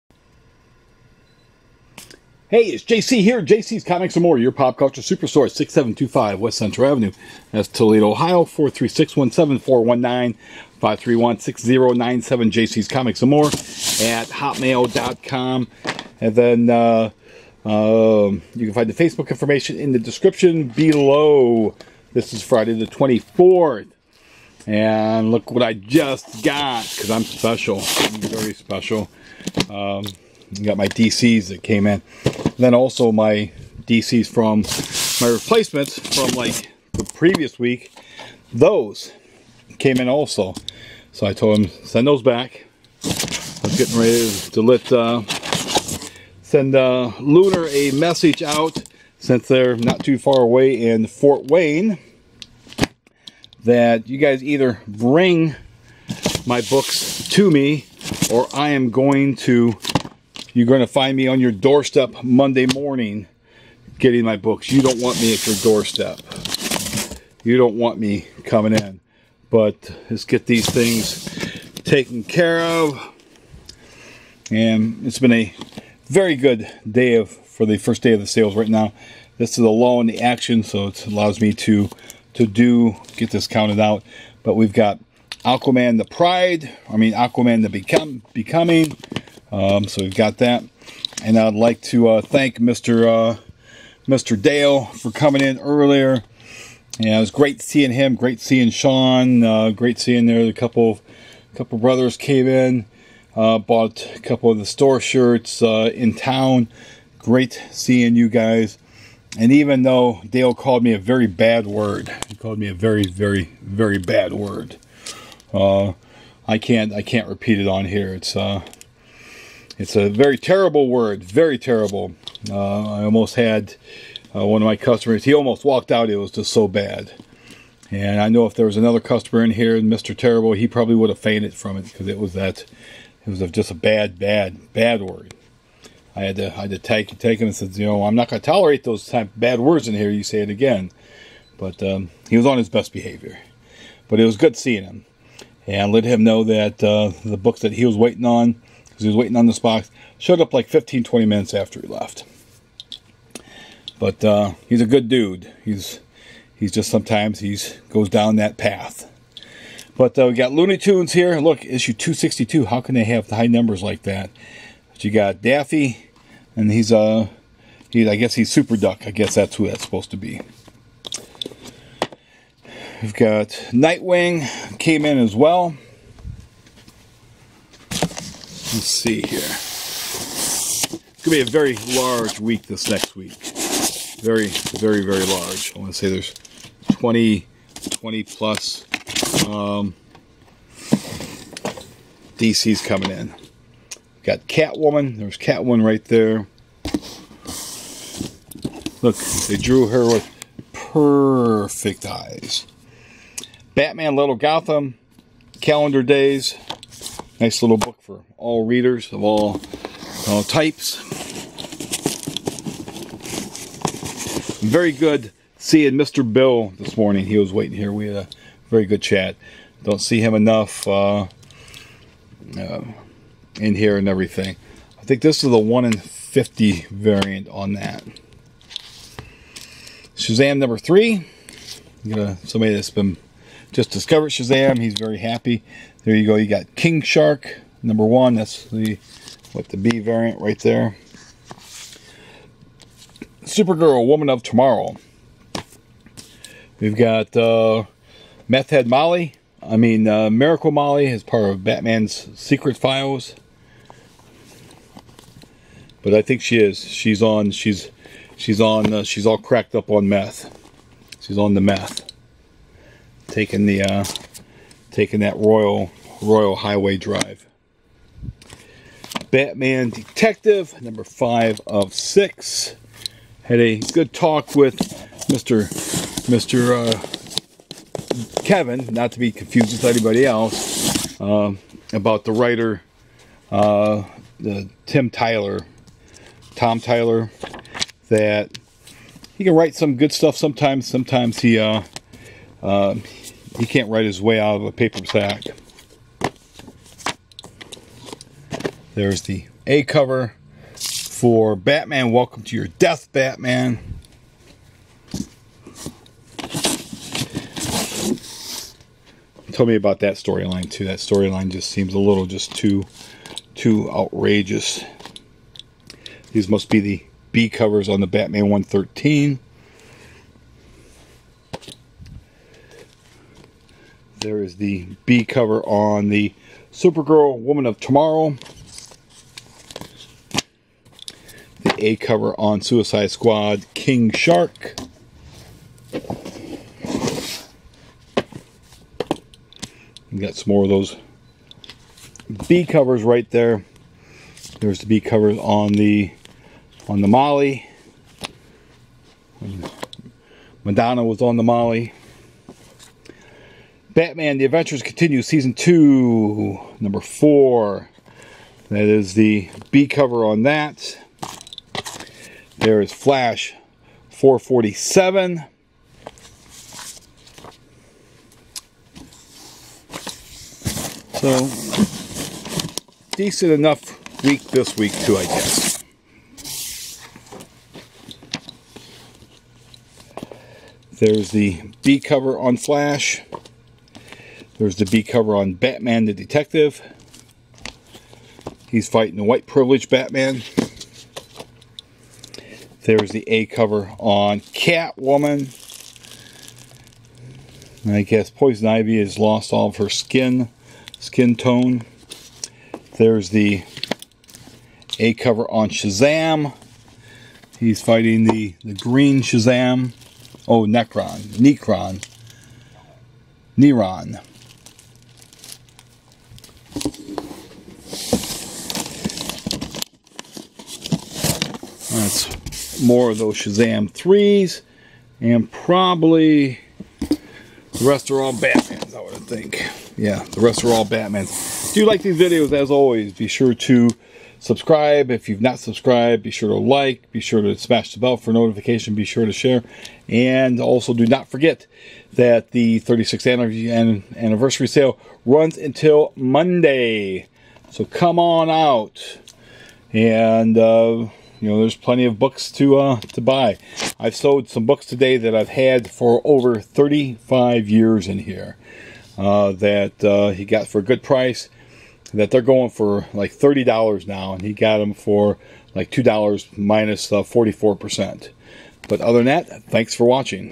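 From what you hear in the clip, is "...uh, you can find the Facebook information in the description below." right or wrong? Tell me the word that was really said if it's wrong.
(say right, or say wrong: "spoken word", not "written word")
right.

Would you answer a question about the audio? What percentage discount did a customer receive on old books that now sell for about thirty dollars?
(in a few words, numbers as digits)
44%.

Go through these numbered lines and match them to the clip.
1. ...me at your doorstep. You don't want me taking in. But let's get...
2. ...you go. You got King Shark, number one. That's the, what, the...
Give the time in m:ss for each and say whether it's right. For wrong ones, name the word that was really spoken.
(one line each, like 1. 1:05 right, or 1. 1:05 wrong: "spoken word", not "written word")
1. 1:05 wrong: "coming", not "taking"
2. 3:56 right.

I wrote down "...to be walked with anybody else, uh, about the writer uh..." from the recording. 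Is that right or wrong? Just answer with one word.
wrong.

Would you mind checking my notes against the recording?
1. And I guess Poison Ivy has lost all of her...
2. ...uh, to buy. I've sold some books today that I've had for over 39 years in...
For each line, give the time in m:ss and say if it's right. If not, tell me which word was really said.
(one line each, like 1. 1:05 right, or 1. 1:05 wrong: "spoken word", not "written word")
1. 6:37 right
2. 7:32 wrong: "35", not "39".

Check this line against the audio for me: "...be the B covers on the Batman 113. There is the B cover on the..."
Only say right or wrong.
right.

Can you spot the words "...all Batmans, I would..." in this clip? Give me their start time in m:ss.
7:08.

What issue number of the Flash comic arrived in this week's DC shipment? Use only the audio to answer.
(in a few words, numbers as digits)
447.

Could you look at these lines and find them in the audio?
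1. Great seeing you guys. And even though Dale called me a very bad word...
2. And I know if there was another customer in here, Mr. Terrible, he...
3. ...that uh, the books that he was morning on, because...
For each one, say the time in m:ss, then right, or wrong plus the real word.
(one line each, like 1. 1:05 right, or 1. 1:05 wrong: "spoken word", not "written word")
1. 1:47 right
2. 2:07 right
3. 2:26 wrong: "waiting", not "morning".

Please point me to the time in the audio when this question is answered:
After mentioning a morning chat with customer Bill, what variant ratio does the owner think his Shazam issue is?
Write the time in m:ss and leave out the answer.
3:45.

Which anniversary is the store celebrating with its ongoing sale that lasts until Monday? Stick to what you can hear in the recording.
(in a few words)
36th.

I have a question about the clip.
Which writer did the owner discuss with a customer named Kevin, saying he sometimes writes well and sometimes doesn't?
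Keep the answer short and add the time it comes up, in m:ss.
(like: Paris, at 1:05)
Tom Taylor, at 4:46.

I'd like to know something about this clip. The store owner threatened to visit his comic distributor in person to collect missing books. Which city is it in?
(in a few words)
Fort Wayne.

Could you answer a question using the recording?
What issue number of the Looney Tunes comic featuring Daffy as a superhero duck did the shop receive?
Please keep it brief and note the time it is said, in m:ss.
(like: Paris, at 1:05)
262, at 2:41.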